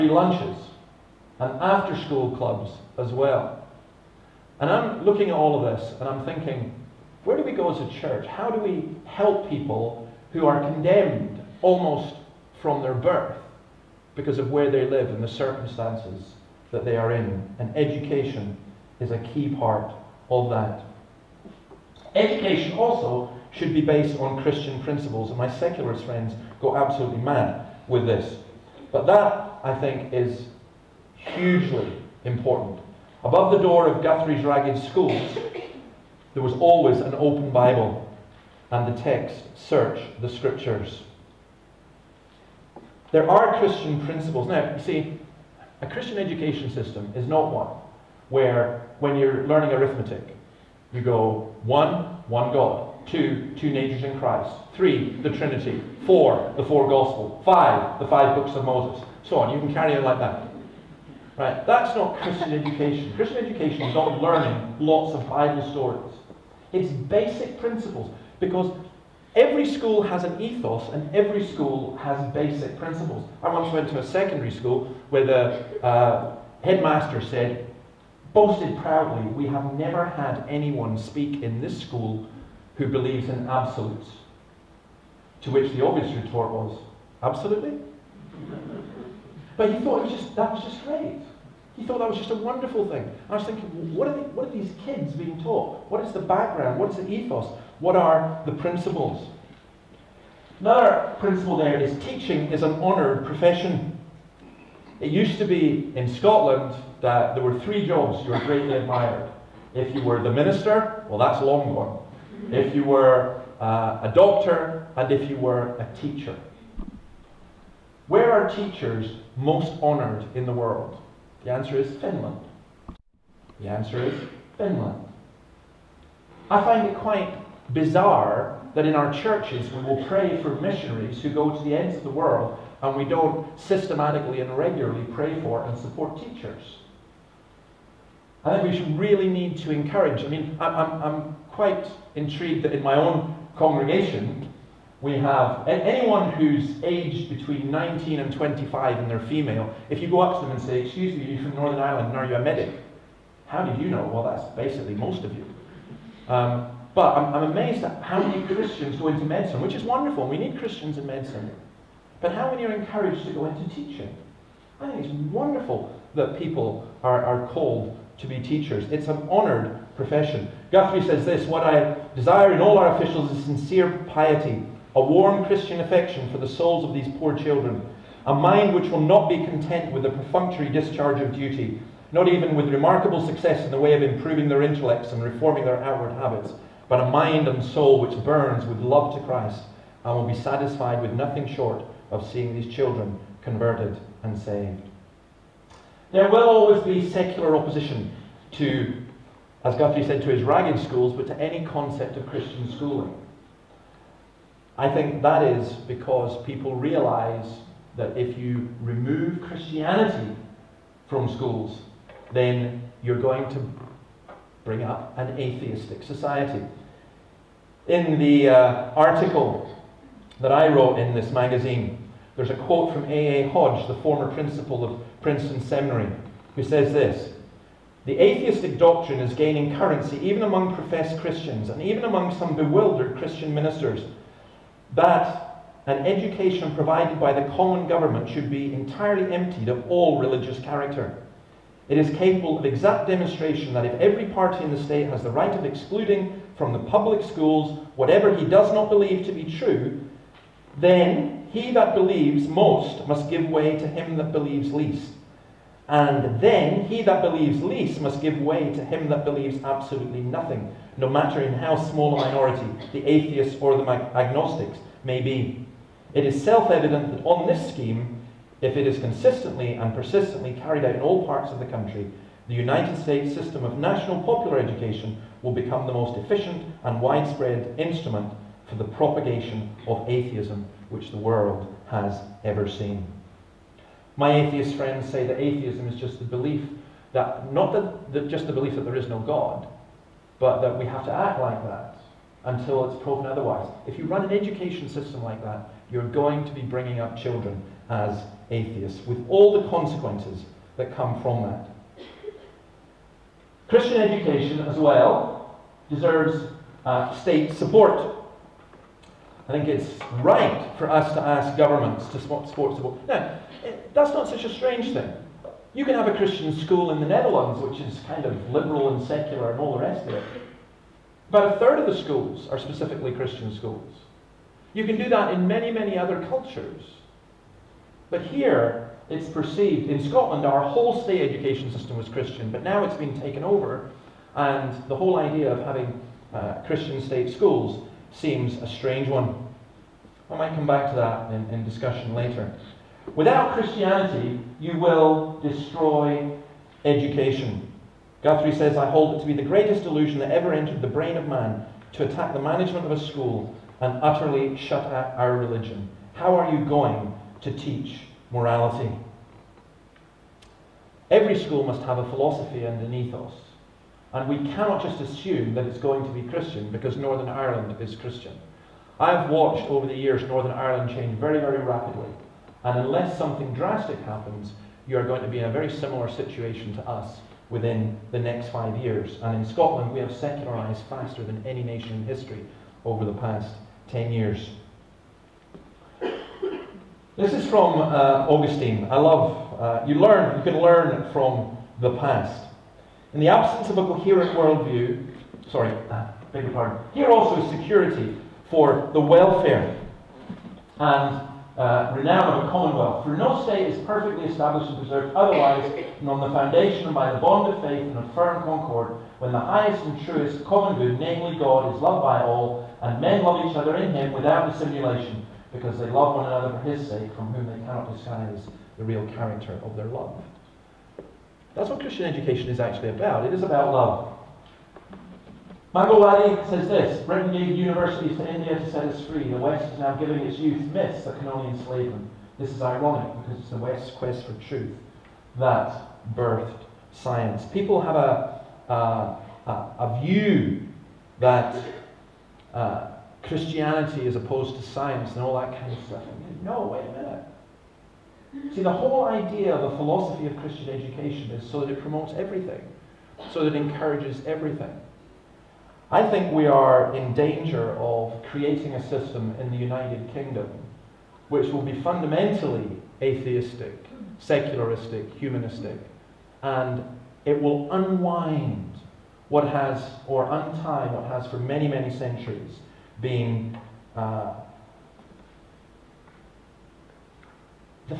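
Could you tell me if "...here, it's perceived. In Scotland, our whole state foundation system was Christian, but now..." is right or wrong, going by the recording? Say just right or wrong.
wrong.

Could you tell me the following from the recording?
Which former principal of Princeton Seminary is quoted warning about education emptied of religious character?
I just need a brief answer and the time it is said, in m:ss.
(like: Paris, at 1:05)
A. A. Hodge, at 3:43.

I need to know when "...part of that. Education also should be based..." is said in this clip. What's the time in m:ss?
0:19.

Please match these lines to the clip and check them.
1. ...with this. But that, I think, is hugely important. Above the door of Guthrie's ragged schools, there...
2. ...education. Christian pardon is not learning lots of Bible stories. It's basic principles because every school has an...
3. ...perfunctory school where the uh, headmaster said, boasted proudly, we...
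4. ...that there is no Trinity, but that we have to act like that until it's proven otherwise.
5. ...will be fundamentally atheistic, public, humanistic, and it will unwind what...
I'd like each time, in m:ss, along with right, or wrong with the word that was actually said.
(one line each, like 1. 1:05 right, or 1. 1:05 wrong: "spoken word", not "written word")
1. 0:27 right
2. 1:02 wrong: "education", not "pardon"
3. 1:14 wrong: "secondary", not "perfunctory"
4. 4:48 wrong: "God", not "Trinity"
5. 7:41 wrong: "secularistic", not "public".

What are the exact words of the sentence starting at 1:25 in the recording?
To which the obvious retort was, absolutely.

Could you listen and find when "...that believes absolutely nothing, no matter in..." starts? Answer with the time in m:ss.
4:19.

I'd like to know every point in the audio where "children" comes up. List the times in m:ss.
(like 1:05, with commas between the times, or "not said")
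2:57, 3:12, 4:57.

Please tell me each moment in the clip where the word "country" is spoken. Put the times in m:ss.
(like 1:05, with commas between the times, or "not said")
4:31.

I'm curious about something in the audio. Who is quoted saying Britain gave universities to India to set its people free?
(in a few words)
Mangalwadi.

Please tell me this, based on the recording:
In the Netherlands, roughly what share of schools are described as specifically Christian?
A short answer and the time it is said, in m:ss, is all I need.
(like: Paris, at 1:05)
About a third, at 5:21.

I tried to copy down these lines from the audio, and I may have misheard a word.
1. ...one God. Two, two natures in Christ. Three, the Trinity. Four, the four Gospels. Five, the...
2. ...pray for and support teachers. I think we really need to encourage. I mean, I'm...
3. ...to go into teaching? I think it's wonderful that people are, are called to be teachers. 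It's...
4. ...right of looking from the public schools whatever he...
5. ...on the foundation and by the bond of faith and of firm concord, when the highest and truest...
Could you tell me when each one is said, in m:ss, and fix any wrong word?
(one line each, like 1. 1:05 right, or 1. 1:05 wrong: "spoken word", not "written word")
1. 0:52 right
2. 2:15 right
3. 2:43 right
4. 4:05 wrong: "excluding", not "looking"
5. 6:46 right.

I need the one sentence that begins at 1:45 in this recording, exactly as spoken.
It used to be in Scotland that there were three jobs you were greatly admired.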